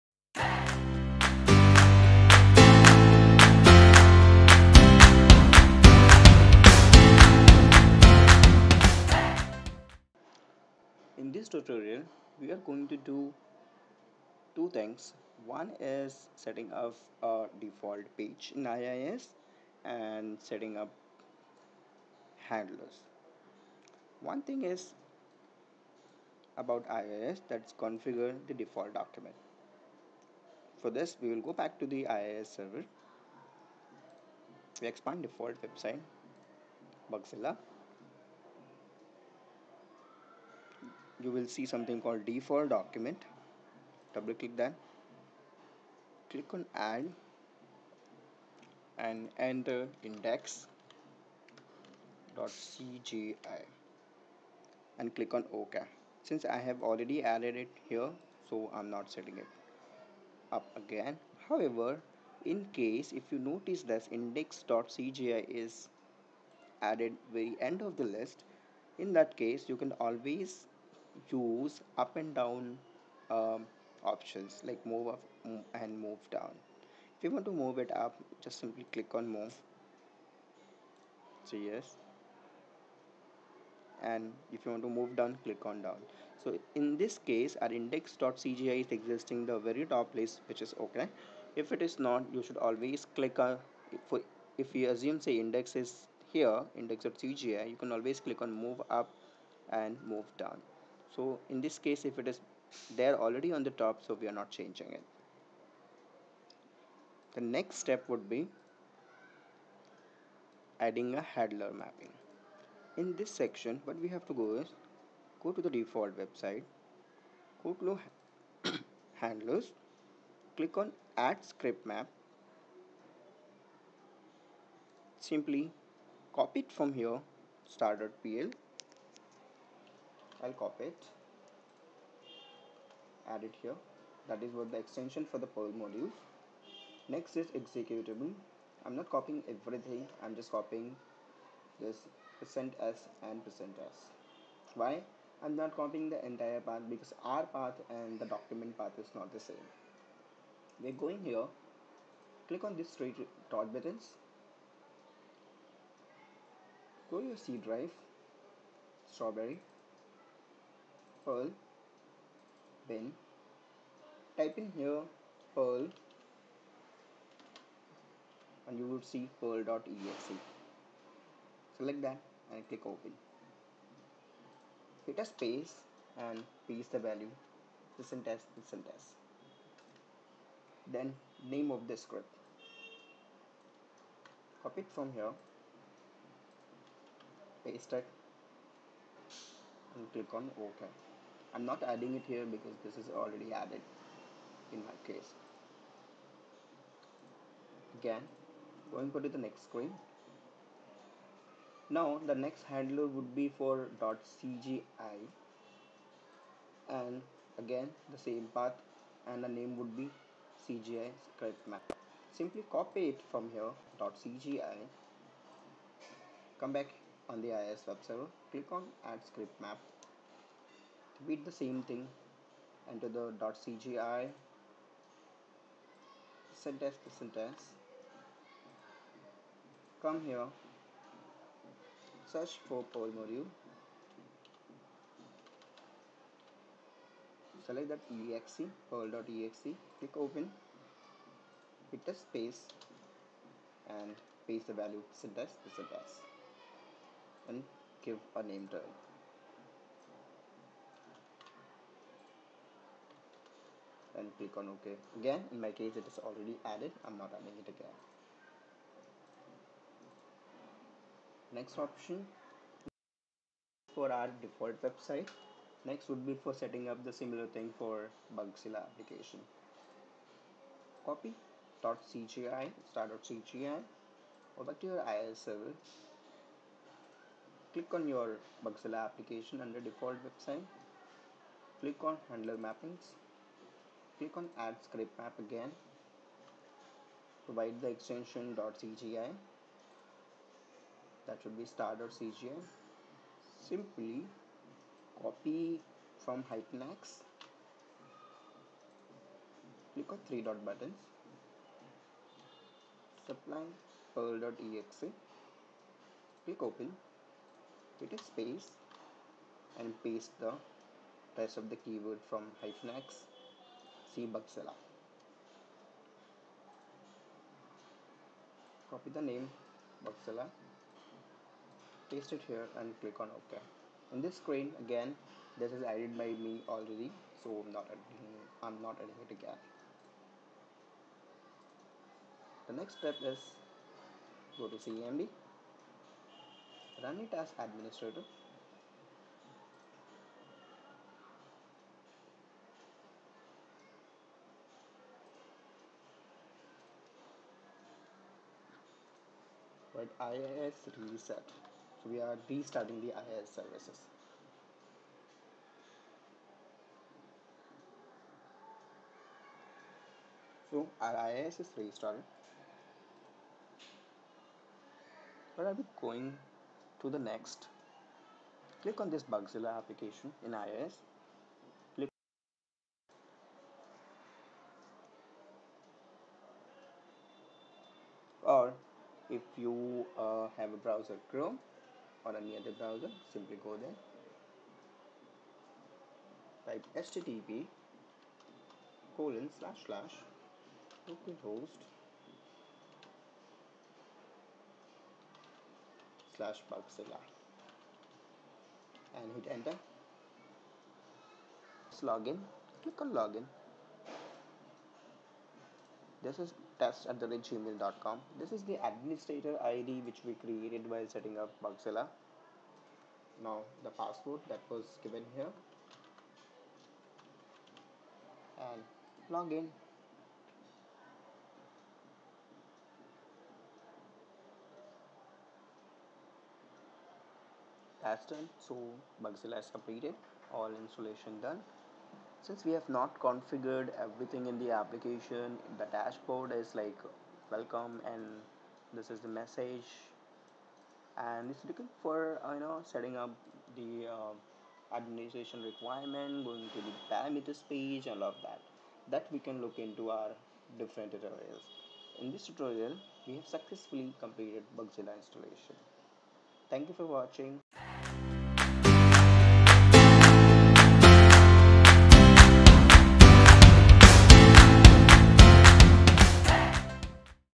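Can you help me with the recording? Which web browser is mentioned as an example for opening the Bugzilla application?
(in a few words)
Chrome.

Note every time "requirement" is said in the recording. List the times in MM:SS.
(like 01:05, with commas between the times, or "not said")
07:25.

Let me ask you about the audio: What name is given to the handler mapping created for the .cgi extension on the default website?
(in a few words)
CGI script map.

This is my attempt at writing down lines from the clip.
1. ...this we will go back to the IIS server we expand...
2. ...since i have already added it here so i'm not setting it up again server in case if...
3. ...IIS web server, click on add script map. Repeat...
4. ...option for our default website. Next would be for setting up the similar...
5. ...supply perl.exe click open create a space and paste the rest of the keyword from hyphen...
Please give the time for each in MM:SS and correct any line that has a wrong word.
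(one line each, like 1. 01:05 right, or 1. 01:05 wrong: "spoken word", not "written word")
1. 00:31 right
2. 00:56 wrong: "however", not "server"
3. 03:37 right
4. 04:21 right
5. 05:03 right.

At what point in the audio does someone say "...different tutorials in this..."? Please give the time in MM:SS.
07:30.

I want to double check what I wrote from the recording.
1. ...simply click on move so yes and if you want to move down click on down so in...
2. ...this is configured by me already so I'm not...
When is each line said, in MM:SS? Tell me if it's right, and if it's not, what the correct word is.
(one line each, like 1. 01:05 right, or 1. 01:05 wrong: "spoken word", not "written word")
1. 01:18 right
2. 05:25 wrong: "added", not "configured".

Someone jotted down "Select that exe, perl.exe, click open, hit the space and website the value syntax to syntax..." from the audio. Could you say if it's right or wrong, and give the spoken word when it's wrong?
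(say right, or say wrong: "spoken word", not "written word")
wrong: "paste", not "website".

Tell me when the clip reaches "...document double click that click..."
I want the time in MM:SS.
00:42.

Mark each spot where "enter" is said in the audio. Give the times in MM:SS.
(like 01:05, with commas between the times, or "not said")
00:49, 03:42, 06:39.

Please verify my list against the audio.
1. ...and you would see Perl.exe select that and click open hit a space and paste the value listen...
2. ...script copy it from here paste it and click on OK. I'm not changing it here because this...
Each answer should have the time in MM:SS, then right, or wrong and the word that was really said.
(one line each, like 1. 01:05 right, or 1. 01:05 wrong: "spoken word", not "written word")
1. 02:48 right
2. 03:02 wrong: "adding", not "changing".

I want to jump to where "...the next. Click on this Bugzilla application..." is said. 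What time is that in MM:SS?
06:07.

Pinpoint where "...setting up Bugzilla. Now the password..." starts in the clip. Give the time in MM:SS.
06:51.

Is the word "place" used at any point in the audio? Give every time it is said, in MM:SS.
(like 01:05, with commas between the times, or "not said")
01:30.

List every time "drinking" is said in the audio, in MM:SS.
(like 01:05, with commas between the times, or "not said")
not said.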